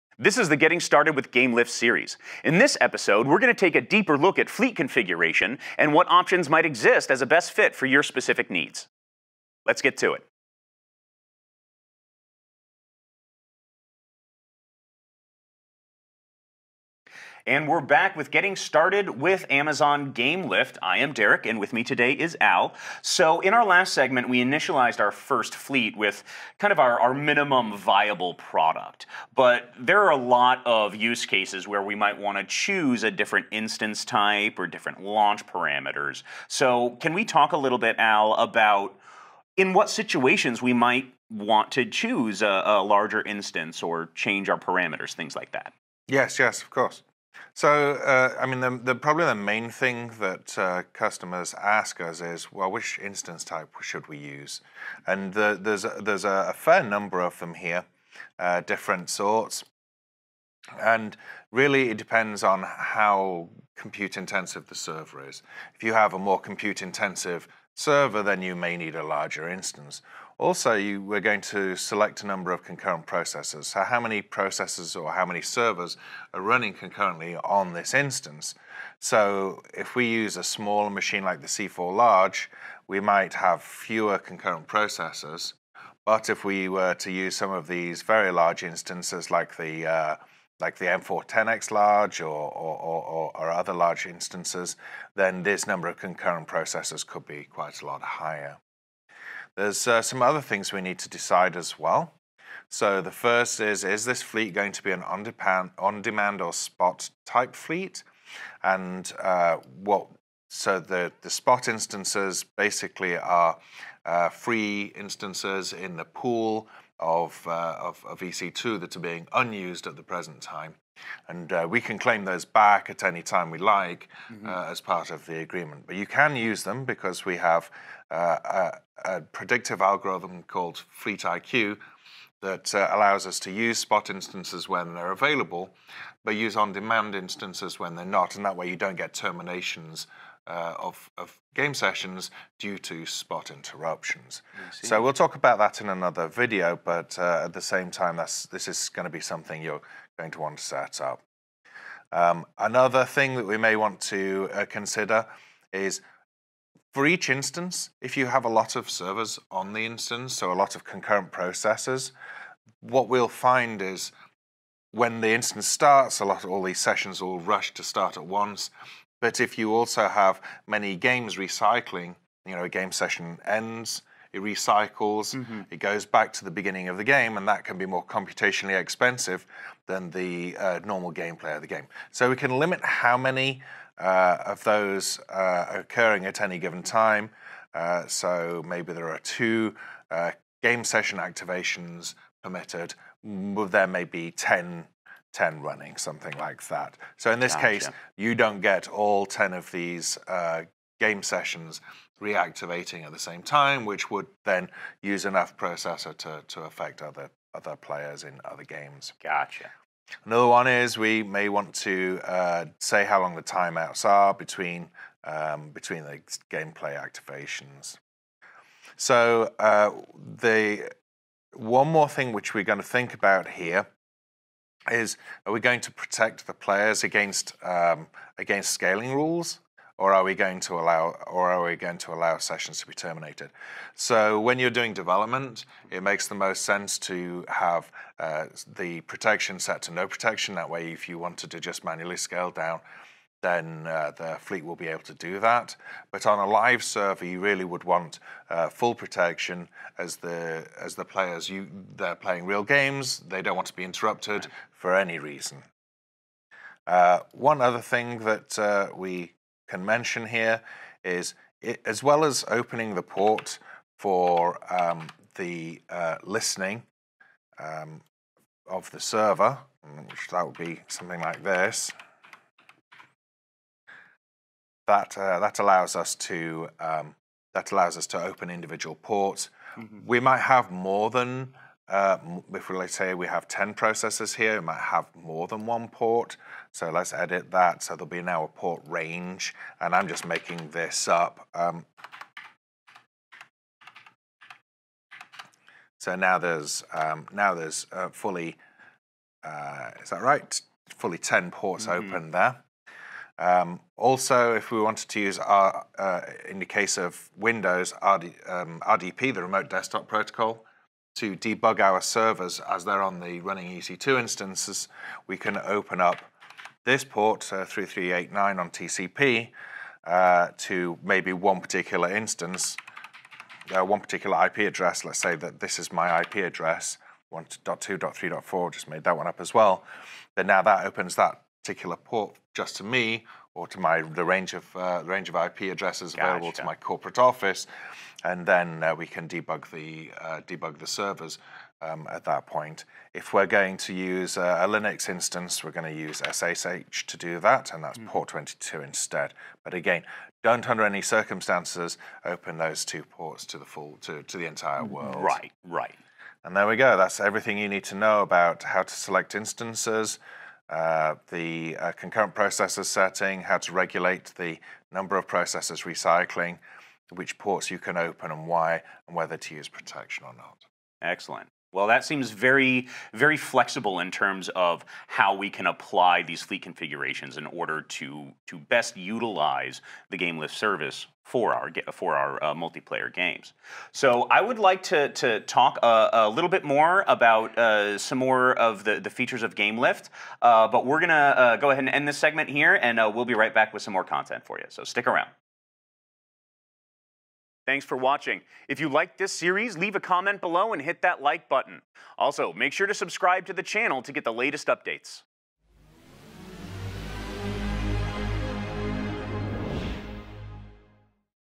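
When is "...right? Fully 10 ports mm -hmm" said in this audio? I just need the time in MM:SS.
05:00.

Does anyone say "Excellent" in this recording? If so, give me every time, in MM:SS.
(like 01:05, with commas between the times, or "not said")
06:11.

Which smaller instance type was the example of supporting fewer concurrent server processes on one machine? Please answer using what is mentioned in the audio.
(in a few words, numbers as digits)
C4 Large.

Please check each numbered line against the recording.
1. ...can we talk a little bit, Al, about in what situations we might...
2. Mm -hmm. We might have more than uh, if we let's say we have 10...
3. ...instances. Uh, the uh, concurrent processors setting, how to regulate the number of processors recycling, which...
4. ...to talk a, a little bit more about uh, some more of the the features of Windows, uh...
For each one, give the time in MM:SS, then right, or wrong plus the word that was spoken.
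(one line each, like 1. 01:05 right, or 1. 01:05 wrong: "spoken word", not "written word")
1. 00:36 right
2. 04:39 right
3. 05:59 right
4. 06:25 wrong: "GameLift", not "Windows".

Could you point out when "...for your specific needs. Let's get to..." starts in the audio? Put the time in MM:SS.
00:07.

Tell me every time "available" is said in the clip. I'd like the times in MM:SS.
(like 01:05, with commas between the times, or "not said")
02:15, 05:36.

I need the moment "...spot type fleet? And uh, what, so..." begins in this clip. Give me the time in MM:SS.
01:46.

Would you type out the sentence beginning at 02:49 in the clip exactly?
But if you also have many games recycling, you know, a game session ends, it recycles, mm-hmm.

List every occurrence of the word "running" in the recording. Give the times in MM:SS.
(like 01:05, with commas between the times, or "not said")
01:16, 03:15, 05:13.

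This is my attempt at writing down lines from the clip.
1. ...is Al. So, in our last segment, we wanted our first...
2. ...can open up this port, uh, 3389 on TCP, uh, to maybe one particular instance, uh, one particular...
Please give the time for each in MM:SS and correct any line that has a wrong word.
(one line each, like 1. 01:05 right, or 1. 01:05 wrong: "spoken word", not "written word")
1. 00:22 wrong: "initialized", not "wanted"
2. 05:15 right.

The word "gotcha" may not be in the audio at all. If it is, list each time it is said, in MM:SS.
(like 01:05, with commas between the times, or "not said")
03:17, 03:29.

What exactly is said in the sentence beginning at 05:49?
But again, don't under any circumstances open those two ports to the full to, to the entire mm, world.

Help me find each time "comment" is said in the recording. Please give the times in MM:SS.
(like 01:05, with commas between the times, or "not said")
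06:39.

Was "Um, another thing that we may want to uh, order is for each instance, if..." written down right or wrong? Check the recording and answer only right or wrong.
wrong.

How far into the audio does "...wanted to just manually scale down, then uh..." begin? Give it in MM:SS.
04:01.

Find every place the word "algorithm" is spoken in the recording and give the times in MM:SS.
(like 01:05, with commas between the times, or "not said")
02:09.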